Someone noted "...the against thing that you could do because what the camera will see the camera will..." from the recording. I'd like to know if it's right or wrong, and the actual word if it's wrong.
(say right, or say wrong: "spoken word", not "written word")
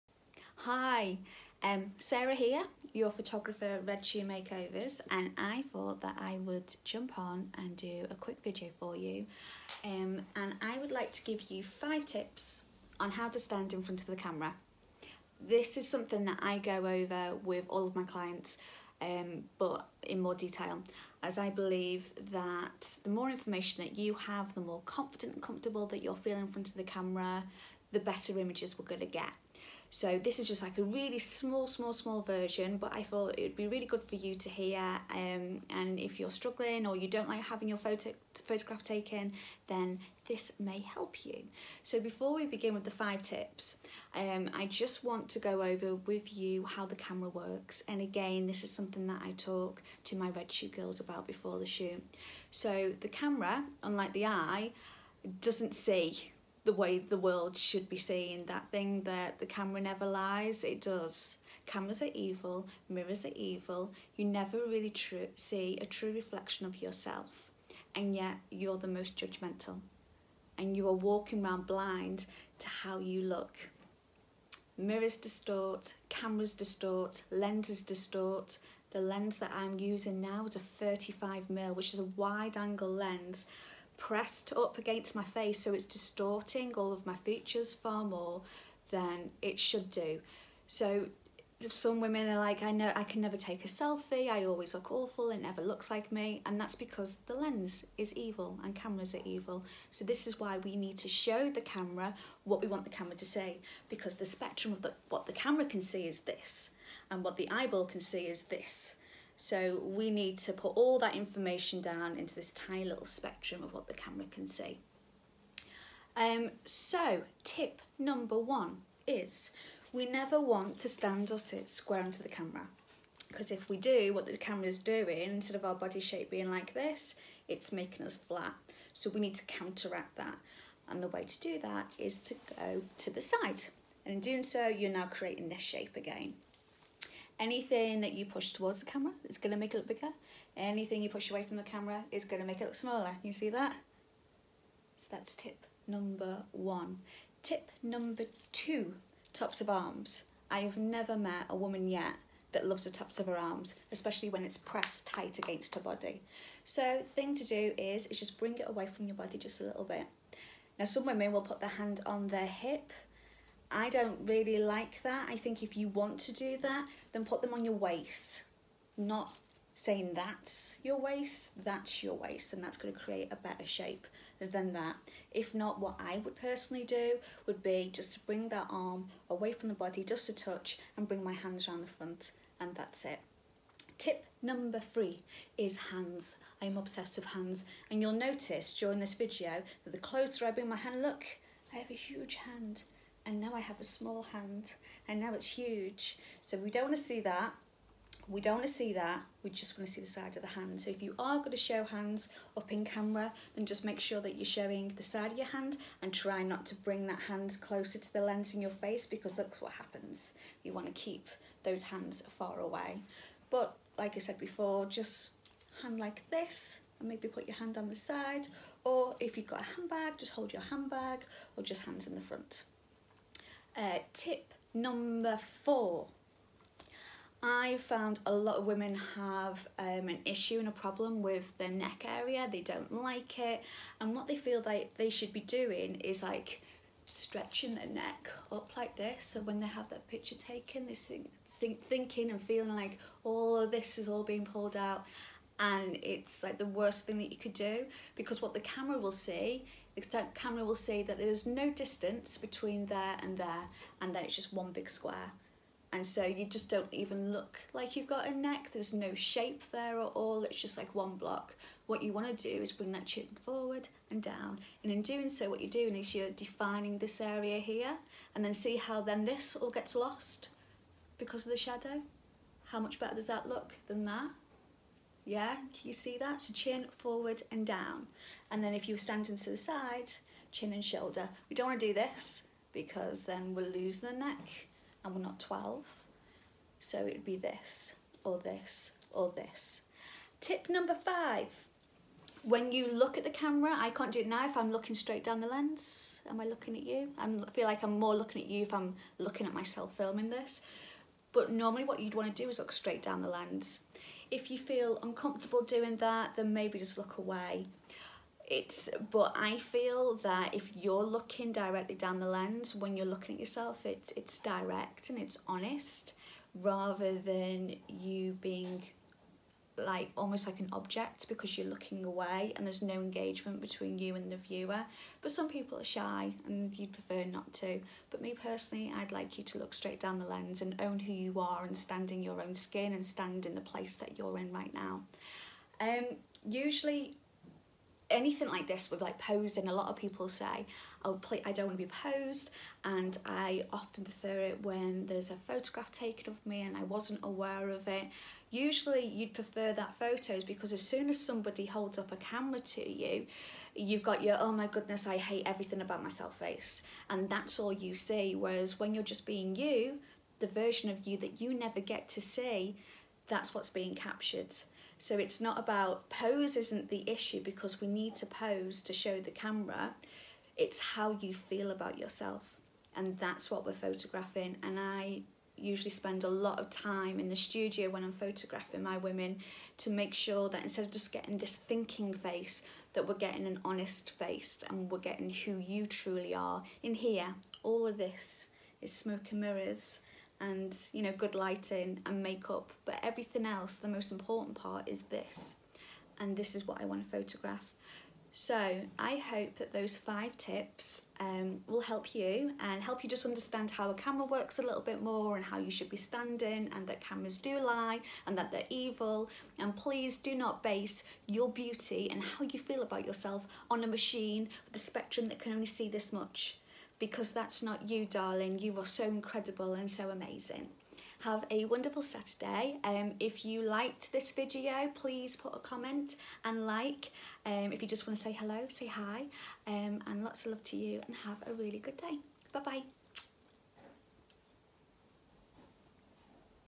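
wrong: "worst", not "against".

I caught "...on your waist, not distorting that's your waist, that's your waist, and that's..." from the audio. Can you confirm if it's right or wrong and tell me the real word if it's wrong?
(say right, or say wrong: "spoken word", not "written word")
wrong: "saying", not "distorting".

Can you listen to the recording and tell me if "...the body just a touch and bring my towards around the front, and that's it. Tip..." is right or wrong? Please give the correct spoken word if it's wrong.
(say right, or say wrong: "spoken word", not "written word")
wrong: "hands", not "towards".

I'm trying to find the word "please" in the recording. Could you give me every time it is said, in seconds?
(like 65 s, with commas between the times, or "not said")
409 s, 424 s.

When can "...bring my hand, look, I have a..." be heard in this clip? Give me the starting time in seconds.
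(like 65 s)
190 s.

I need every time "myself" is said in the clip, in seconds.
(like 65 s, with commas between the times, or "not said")
299 s, 356 s.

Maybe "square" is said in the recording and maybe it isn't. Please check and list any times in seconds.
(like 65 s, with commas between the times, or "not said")
121 s, 254 s.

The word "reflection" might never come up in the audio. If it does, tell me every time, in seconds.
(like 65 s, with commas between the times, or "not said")
66 s.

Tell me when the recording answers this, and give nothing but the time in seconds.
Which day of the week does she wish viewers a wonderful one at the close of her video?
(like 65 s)
422 s.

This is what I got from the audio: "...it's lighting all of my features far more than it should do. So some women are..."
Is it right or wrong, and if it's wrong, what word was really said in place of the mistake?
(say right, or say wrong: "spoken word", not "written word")
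wrong: "distorting", not "lighting".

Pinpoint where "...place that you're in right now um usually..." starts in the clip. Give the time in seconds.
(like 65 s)
333 s.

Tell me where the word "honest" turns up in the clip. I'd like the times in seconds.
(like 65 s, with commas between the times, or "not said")
315 s, 383 s.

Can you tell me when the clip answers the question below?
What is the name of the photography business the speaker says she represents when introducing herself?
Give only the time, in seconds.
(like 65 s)
3 s.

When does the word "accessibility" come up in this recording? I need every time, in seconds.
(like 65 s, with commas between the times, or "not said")
not said.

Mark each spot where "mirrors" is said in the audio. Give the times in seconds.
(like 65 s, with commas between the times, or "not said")
62 s, 74 s, 389 s.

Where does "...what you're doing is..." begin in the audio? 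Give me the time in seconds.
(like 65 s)
265 s.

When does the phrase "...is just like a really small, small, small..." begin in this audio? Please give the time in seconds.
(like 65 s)
30 s.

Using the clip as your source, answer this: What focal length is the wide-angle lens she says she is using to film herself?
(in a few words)
35mm.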